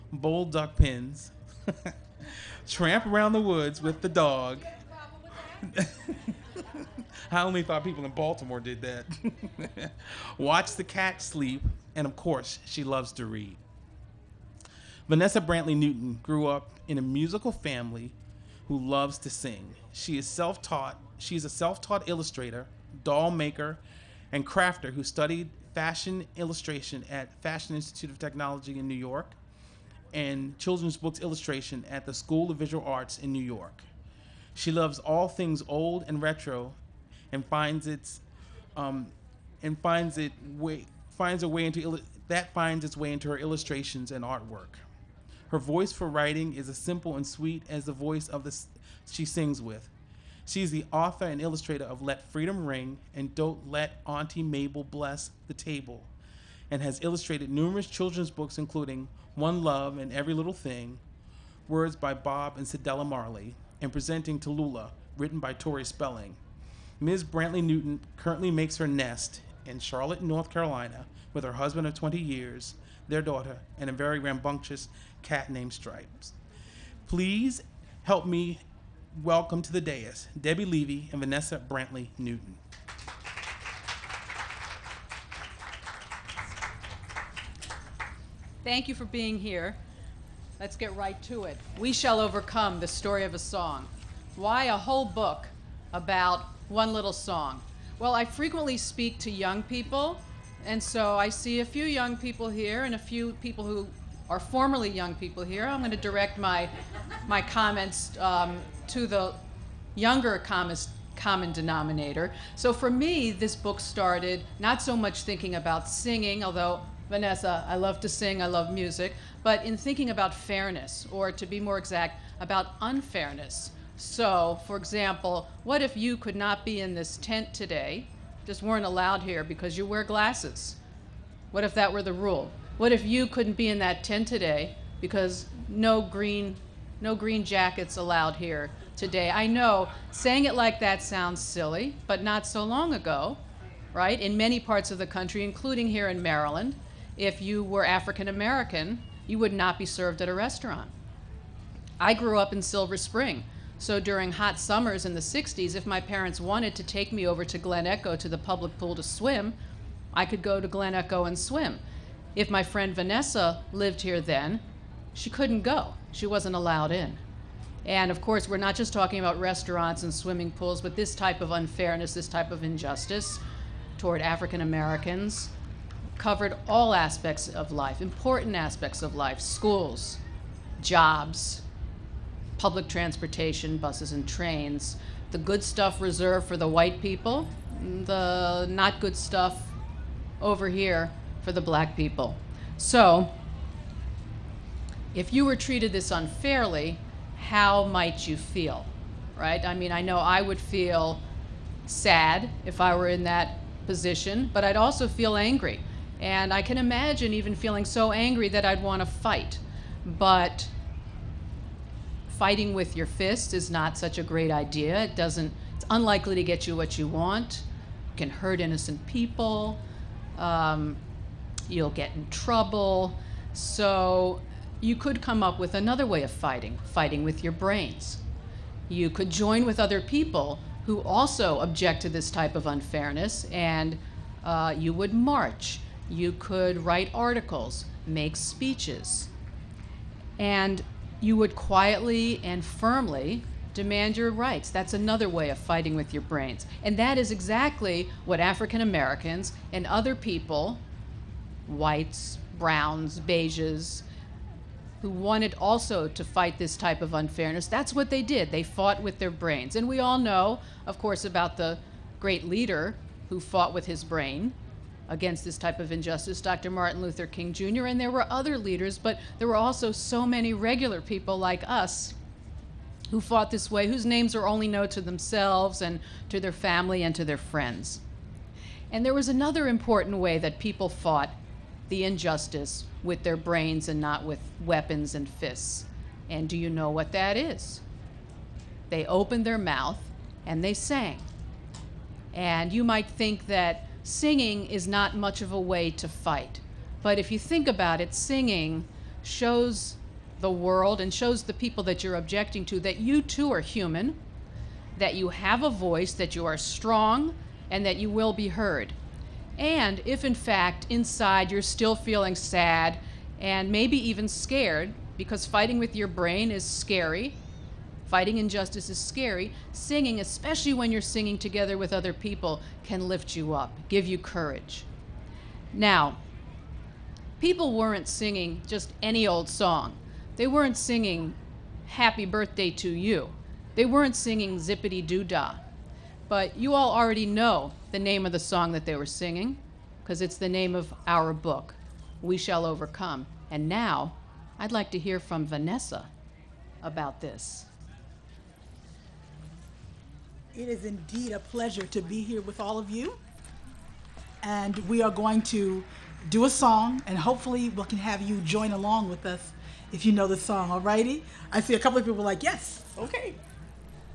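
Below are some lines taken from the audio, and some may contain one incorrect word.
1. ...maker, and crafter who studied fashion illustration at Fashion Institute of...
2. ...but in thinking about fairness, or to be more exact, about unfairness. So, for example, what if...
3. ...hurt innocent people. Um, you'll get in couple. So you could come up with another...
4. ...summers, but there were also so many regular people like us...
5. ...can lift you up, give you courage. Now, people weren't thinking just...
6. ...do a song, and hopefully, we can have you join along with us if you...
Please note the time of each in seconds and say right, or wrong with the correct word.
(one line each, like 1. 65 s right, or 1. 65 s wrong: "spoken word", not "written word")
1. 23 s right
2. 119 s right
3. 218 s wrong: "trouble", not "couple"
4. 268 s wrong: "leaders", not "summers"
5. 322 s wrong: "singing", not "thinking"
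6. 356 s right.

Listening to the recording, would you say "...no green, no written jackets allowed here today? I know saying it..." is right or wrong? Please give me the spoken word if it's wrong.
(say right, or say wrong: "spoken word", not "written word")
wrong: "green", not "written".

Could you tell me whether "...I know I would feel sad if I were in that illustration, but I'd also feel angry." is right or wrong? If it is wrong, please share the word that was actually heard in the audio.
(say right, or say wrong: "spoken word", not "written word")
wrong: "position", not "illustration".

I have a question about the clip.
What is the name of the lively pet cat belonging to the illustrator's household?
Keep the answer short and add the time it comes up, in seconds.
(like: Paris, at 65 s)
Stripes, at 75 s.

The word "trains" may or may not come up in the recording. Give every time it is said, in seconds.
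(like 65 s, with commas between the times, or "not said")
184 s.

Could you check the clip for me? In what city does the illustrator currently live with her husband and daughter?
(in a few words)
Charlotte, North Carolina.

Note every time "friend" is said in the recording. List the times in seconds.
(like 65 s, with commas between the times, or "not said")
162 s, 277 s.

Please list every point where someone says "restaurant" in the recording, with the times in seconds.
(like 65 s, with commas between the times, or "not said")
150 s, 169 s.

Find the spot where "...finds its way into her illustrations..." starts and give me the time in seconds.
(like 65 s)
42 s.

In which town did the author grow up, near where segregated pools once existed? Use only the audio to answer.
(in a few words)
Silver Spring.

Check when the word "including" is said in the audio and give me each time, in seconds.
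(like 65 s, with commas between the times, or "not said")
58 s, 145 s.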